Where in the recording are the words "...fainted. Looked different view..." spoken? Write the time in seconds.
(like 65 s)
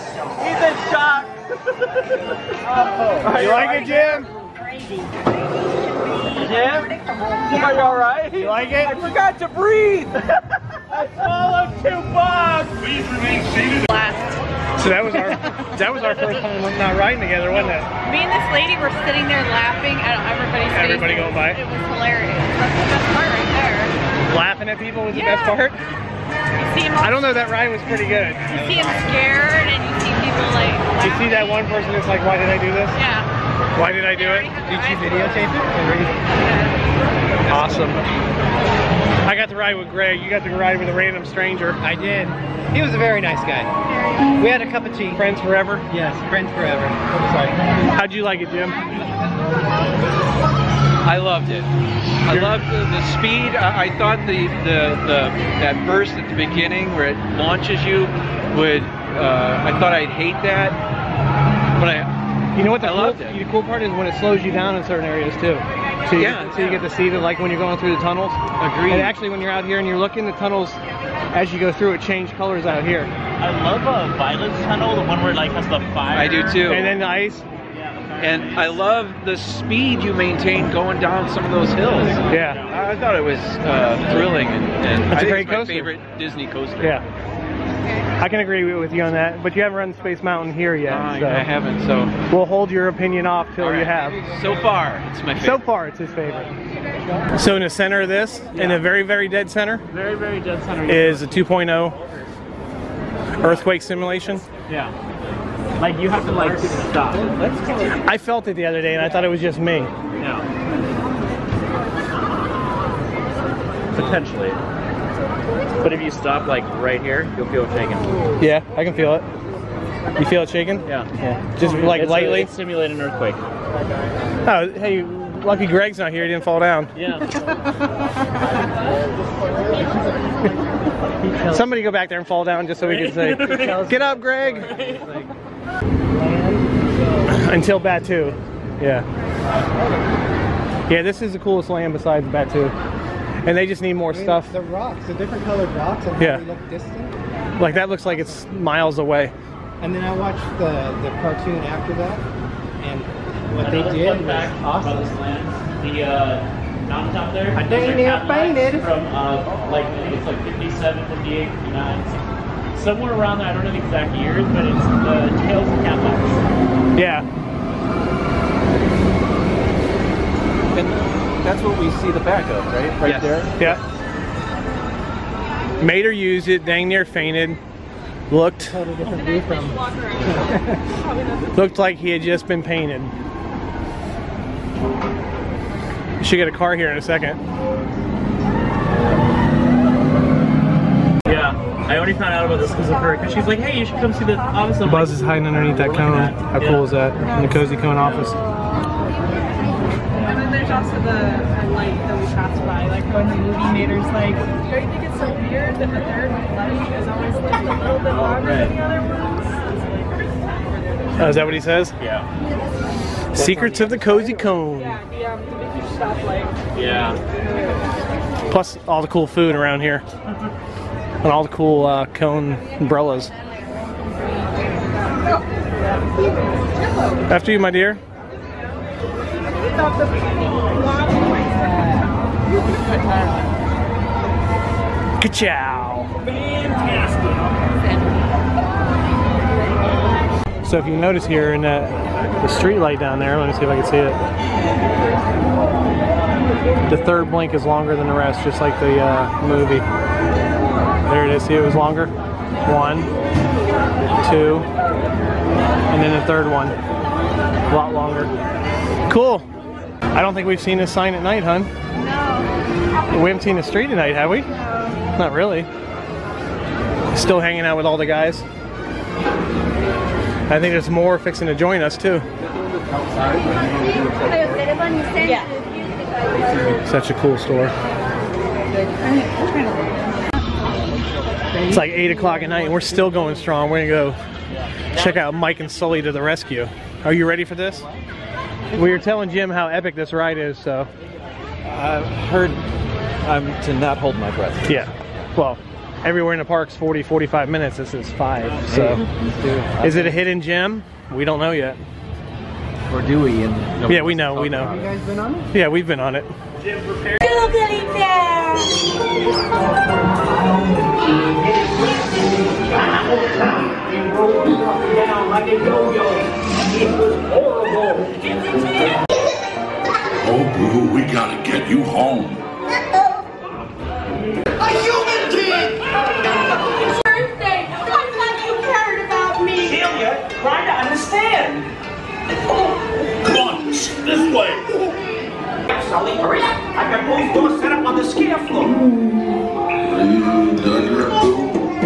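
177 s.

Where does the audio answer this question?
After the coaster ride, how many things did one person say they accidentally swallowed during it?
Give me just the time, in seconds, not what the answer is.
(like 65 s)
11 s.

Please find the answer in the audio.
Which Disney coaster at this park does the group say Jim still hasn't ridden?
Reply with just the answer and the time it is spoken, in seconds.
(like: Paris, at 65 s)
Space Mountain, at 89 s.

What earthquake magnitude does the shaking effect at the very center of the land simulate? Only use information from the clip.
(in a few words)
2.0.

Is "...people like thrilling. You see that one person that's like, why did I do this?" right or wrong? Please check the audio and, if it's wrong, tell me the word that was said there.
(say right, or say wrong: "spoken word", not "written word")
wrong: "laughing", not "thrilling".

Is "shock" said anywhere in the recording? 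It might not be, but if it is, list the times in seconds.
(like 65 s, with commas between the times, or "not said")
0 s.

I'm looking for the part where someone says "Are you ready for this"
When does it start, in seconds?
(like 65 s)
287 s.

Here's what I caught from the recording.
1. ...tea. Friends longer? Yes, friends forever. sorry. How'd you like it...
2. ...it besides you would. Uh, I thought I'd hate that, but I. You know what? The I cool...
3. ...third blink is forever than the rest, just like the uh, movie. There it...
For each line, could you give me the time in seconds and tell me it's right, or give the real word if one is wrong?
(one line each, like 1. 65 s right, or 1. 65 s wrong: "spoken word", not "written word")
1. 44 s wrong: "forever", not "longer"
2. 57 s wrong: "launches", not "besides"
3. 247 s wrong: "longer", not "forever".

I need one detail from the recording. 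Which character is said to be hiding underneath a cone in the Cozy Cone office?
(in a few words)
Buzz.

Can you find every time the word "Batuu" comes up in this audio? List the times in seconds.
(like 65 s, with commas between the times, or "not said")
137 s, 142 s.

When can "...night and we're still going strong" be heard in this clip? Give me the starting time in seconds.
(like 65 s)
282 s.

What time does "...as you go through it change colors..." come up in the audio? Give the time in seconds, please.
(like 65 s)
71 s.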